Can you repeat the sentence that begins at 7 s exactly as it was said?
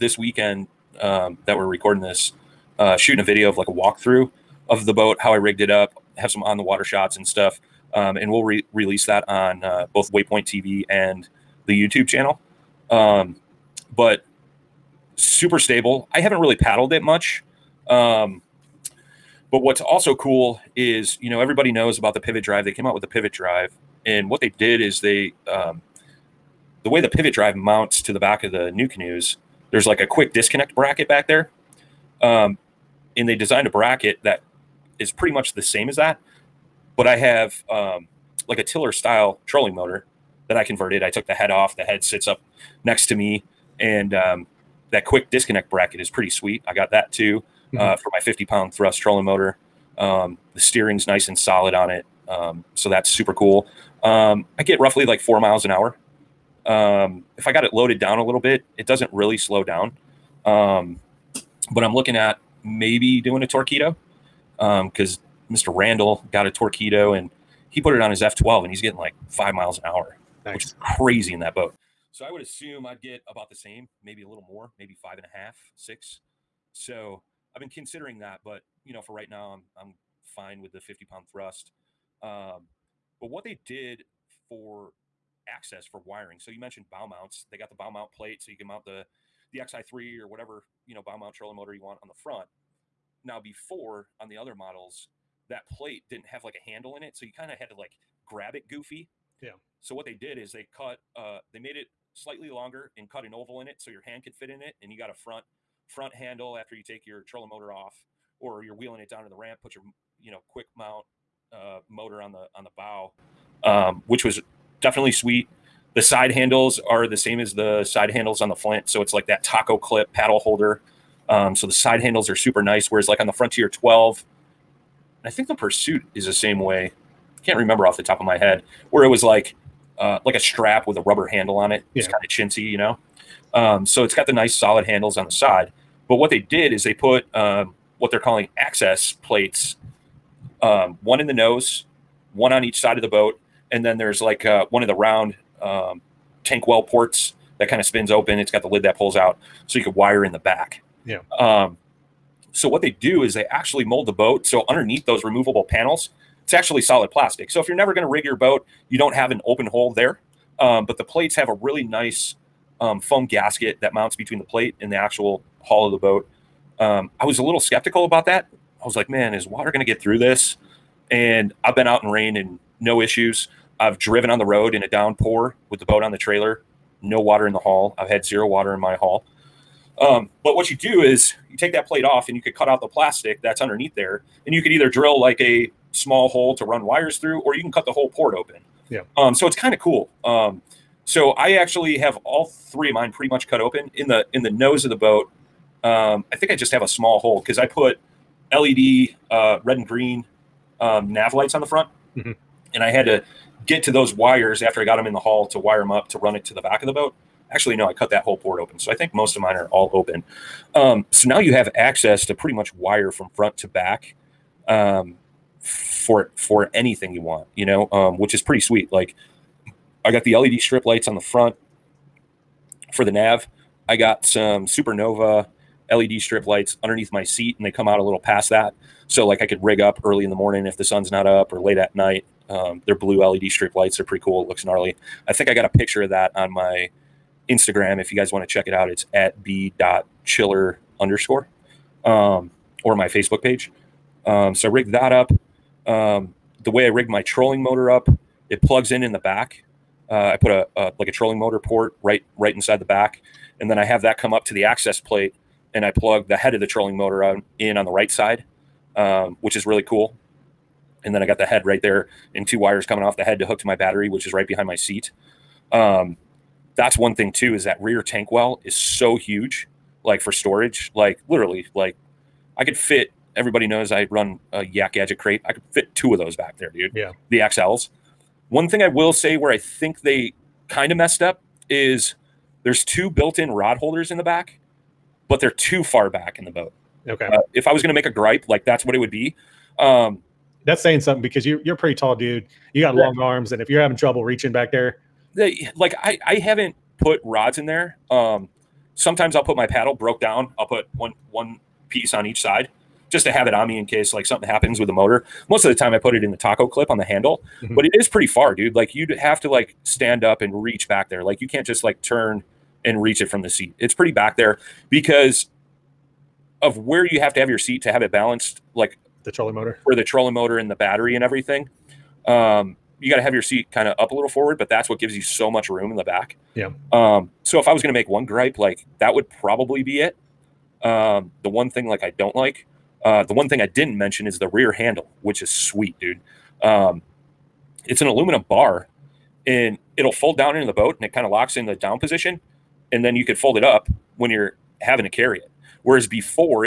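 Um, and we'll re- release that on uh, both Waypoint TV and the YouTube channel.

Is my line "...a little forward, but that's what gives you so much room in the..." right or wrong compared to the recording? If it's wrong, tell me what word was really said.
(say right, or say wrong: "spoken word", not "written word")
right.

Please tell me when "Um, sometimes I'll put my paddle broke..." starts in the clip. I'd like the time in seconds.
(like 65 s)
298 s.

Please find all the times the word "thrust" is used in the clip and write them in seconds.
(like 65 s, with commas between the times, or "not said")
48 s, 81 s.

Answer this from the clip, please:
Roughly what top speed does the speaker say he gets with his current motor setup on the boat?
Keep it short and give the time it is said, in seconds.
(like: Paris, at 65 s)
4 miles an hour, at 55 s.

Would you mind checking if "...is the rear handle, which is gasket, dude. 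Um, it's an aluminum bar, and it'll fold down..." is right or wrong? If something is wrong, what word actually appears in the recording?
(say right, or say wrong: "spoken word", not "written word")
wrong: "sweet", not "gasket".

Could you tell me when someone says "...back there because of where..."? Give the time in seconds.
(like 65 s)
314 s.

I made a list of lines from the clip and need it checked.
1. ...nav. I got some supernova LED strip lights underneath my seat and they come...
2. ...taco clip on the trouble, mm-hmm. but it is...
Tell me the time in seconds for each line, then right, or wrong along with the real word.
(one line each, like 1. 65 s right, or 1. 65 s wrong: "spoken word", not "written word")
1. 223 s right
2. 306 s wrong: "handle", not "trouble".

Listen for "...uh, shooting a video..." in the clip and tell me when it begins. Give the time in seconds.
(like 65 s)
2 s.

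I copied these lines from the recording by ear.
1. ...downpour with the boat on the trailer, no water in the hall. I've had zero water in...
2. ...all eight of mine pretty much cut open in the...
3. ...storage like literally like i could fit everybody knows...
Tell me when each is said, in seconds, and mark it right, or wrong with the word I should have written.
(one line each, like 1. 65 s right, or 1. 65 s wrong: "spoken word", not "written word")
1. 174 s right
2. 192 s wrong: "three", not "eight"
3. 270 s right.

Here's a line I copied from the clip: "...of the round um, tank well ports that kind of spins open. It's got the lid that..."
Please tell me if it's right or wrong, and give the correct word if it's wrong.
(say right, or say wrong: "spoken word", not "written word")
right.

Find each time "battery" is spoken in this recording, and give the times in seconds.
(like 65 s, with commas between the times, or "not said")
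263 s, 320 s.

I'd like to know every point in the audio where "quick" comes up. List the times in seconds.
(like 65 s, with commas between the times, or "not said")
30 s, 45 s, 110 s.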